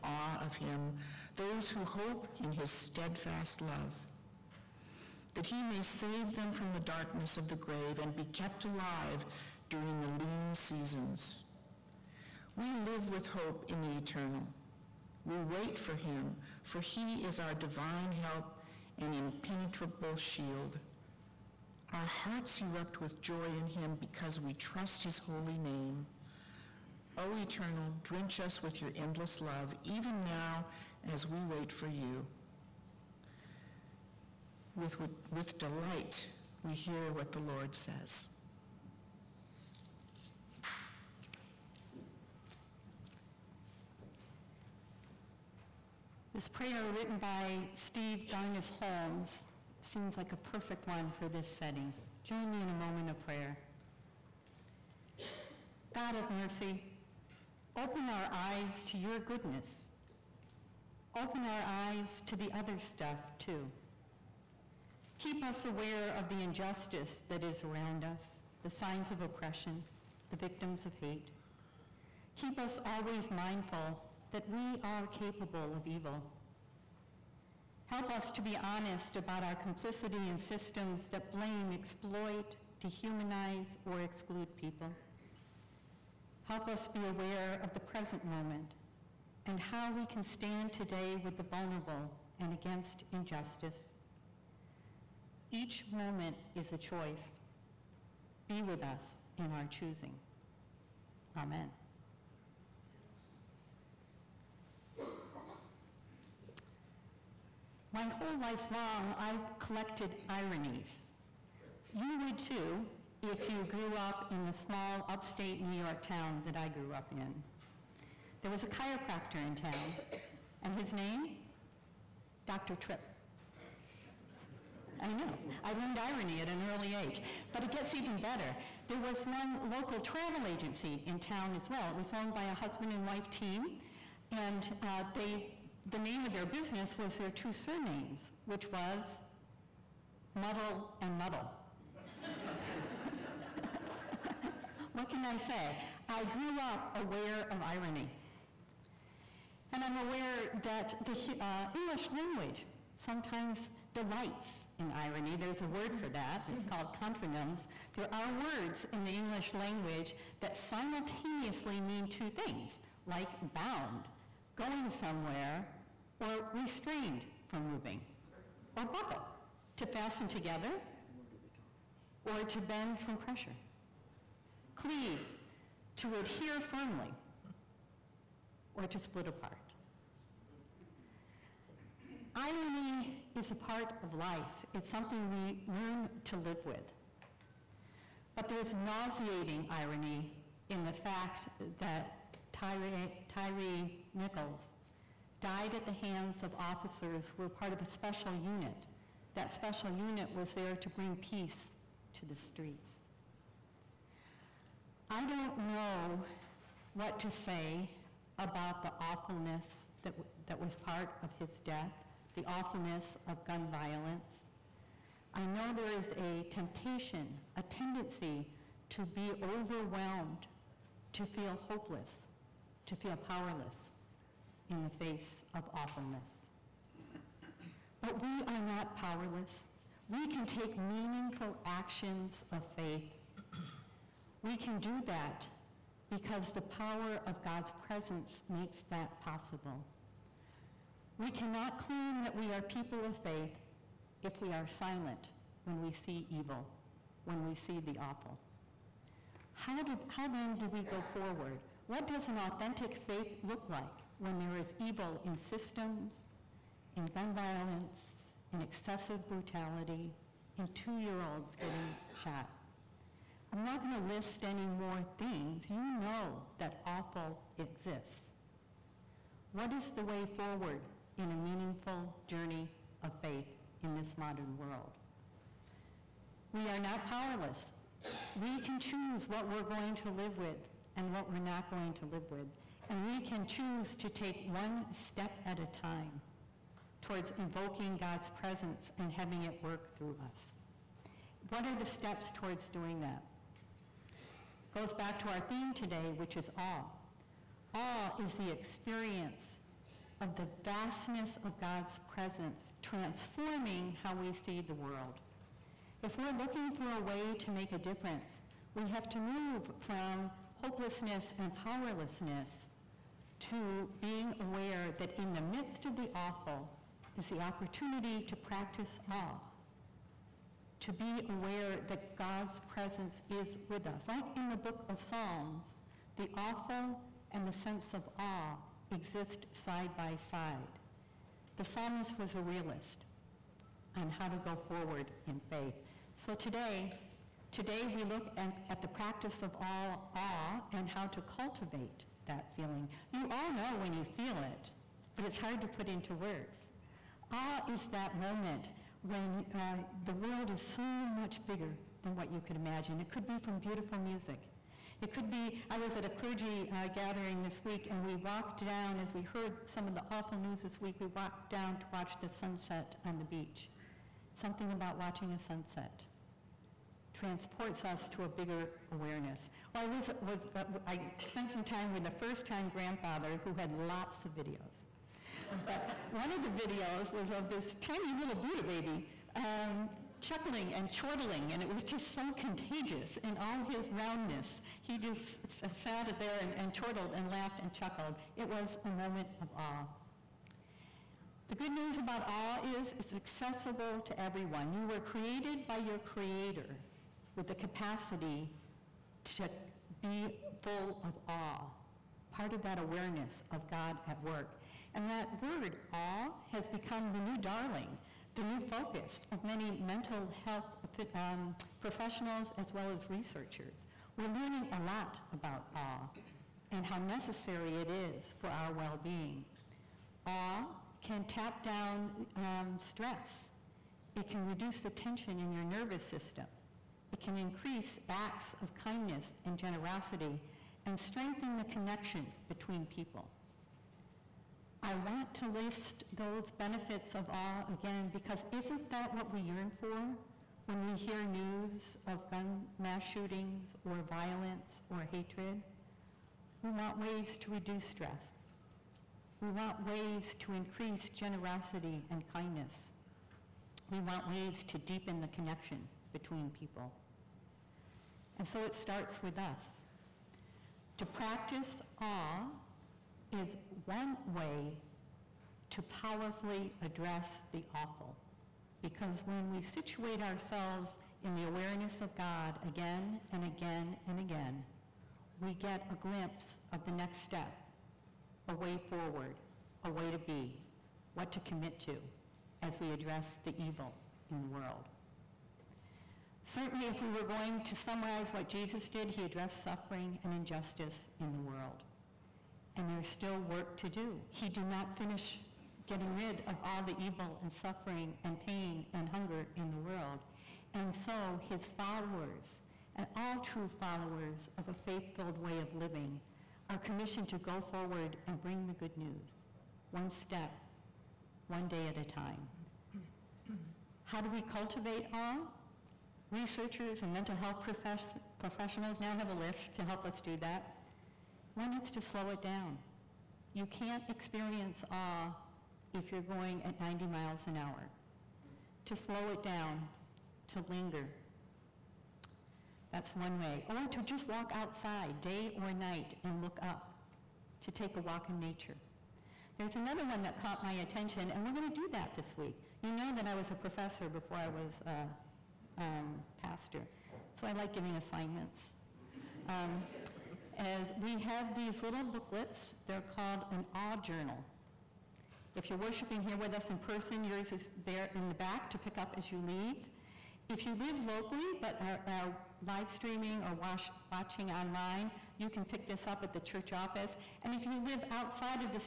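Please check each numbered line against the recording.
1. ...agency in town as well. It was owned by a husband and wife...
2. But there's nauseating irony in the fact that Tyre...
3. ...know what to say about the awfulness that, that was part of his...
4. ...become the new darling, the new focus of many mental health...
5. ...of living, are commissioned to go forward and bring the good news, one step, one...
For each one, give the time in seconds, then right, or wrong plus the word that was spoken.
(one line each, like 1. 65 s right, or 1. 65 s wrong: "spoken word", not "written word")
1. 130 s right
2. 188 s right
3. 205 s right
4. 406 s right
5. 505 s right.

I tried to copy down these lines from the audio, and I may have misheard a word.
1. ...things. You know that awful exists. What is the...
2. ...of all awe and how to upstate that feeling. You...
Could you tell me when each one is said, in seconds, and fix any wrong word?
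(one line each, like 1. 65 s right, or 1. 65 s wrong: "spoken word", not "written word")
1. 265 s right
2. 339 s wrong: "cultivate", not "upstate".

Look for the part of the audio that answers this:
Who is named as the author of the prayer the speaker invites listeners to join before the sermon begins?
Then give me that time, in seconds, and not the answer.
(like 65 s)
47 s.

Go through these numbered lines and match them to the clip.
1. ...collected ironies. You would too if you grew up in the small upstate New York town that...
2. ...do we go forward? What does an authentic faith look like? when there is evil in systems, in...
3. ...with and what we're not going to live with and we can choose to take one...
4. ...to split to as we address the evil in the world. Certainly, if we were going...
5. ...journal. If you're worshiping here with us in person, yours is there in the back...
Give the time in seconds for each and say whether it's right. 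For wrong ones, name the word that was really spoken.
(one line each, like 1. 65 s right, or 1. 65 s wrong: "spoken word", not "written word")
1. 109 s right
2. 250 s right
3. 280 s right
4. 481 s wrong: "commit", not "split"
5. 553 s right.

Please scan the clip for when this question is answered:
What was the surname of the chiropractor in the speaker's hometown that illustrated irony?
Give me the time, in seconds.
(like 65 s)
122 s.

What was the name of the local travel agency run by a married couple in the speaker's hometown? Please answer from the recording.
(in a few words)
Muddle and Muddle.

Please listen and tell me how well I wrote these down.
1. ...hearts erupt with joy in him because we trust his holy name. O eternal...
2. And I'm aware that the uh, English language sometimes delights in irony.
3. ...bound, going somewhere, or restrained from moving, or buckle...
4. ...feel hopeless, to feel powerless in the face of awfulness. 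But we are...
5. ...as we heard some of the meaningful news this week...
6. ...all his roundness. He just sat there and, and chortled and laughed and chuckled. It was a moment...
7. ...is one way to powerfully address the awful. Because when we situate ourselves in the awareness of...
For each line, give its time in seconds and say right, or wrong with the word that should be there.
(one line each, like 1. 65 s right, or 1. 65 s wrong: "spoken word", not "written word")
1. 22 s right
2. 149 s right
3. 163 s right
4. 221 s right
5. 359 s wrong: "awful", not "meaningful"
6. 383 s right
7. 463 s right.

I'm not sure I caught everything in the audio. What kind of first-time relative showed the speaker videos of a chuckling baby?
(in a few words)
grandfather.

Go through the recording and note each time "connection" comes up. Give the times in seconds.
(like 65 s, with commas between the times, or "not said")
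431 s, 455 s.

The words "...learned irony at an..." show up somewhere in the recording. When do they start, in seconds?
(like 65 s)
125 s.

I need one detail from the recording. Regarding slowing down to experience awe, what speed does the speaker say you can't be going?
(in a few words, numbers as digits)
90 miles an hour.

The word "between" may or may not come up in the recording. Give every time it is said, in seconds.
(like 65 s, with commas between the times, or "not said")
432 s, 456 s.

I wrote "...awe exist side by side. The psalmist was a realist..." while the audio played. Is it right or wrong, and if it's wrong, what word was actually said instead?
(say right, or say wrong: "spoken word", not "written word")
right.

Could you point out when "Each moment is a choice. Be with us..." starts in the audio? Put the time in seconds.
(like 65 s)
95 s.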